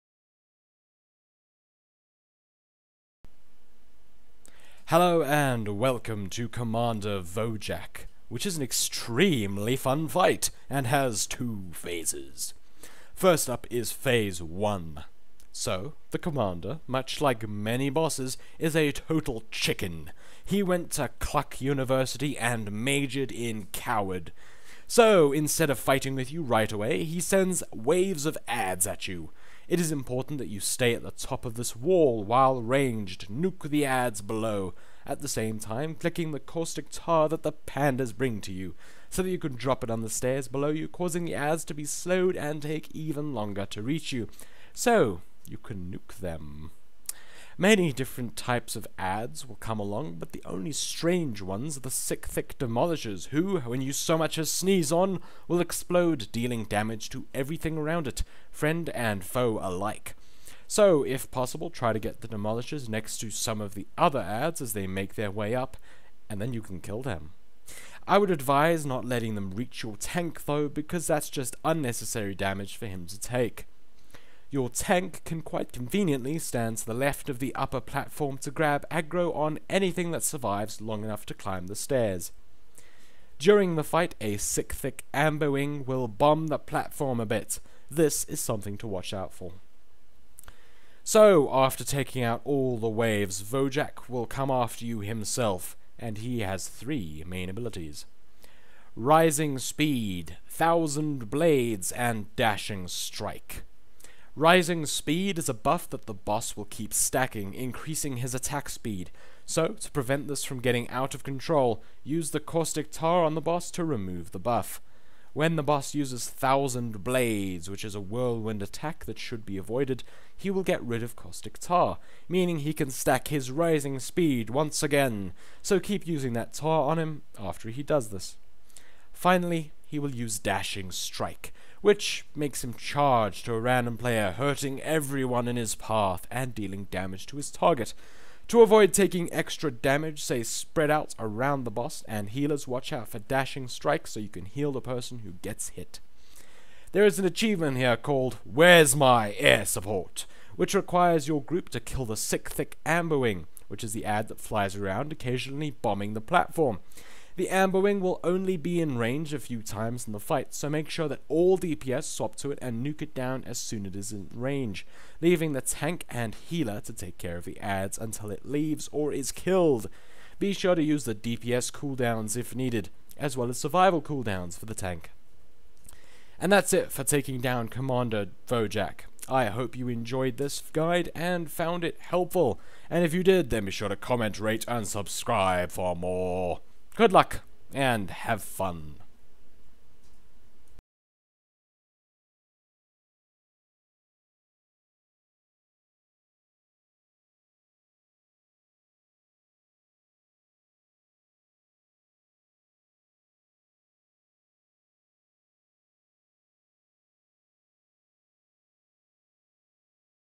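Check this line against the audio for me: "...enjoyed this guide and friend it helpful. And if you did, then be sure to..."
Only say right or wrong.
wrong.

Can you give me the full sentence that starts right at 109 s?
So, to prevent this from getting out of control, use the caustic tar on the boss to remove the buff.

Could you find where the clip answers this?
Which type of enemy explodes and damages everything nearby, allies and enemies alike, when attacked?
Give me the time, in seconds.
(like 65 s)
51 s.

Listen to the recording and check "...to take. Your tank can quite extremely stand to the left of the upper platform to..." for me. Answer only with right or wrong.
wrong.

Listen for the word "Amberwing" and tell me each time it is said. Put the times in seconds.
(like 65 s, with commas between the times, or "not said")
85 s, 152 s.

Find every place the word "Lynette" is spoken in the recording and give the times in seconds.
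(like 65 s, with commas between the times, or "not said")
not said.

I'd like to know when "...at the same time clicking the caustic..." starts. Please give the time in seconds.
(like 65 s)
35 s.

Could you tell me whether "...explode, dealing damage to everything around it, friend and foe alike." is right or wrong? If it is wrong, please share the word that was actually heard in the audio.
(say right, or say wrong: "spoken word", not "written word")
right.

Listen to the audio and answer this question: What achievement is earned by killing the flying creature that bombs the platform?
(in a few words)
Where's My Air Support.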